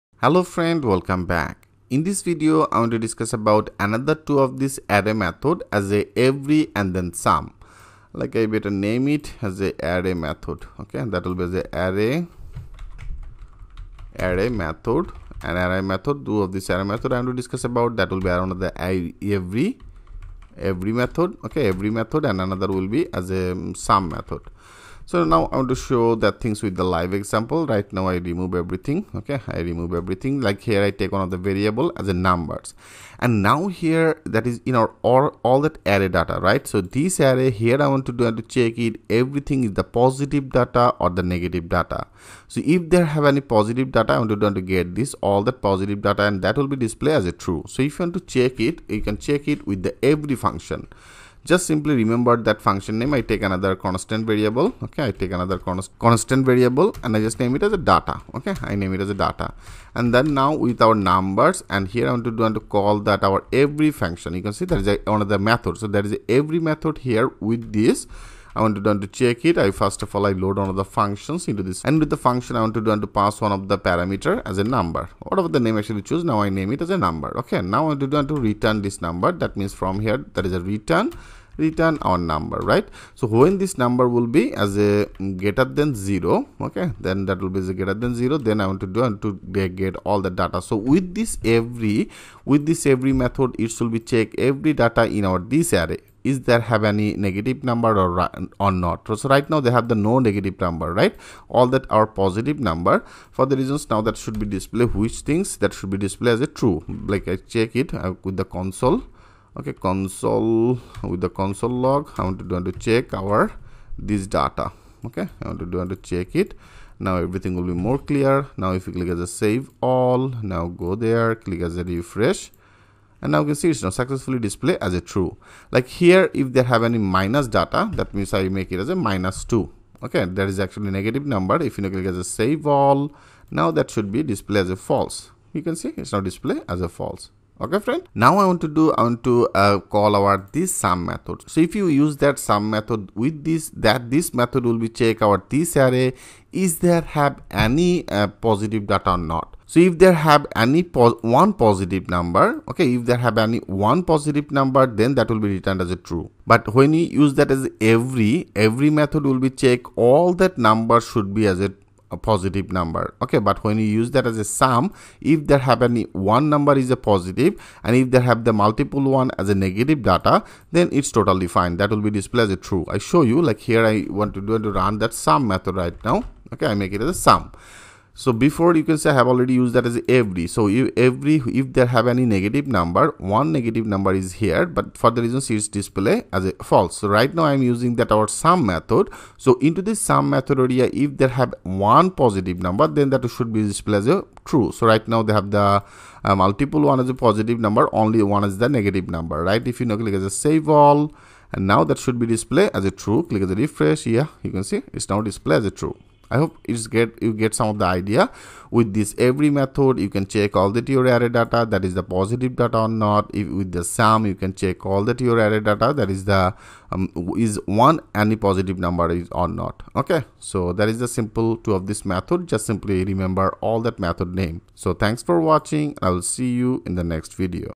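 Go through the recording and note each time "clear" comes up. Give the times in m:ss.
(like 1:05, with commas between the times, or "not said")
1:57.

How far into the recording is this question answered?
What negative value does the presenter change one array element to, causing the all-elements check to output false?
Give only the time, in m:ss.
2:08.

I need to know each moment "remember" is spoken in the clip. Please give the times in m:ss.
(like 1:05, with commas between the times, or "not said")
0:51, 3:43.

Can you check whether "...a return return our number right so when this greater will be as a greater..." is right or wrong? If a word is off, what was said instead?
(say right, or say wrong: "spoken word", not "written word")
wrong: "number", not "greater".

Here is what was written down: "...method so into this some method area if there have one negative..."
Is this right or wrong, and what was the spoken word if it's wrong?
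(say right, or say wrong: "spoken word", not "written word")
wrong: "positive", not "negative".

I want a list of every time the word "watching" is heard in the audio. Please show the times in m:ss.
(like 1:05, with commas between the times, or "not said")
3:45.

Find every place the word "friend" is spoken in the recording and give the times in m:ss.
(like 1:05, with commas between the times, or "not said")
0:00, 2:17.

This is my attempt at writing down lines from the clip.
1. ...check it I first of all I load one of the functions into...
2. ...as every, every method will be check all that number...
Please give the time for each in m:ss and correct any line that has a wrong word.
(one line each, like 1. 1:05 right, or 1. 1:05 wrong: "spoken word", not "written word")
1. 1:09 right
2. 2:37 right.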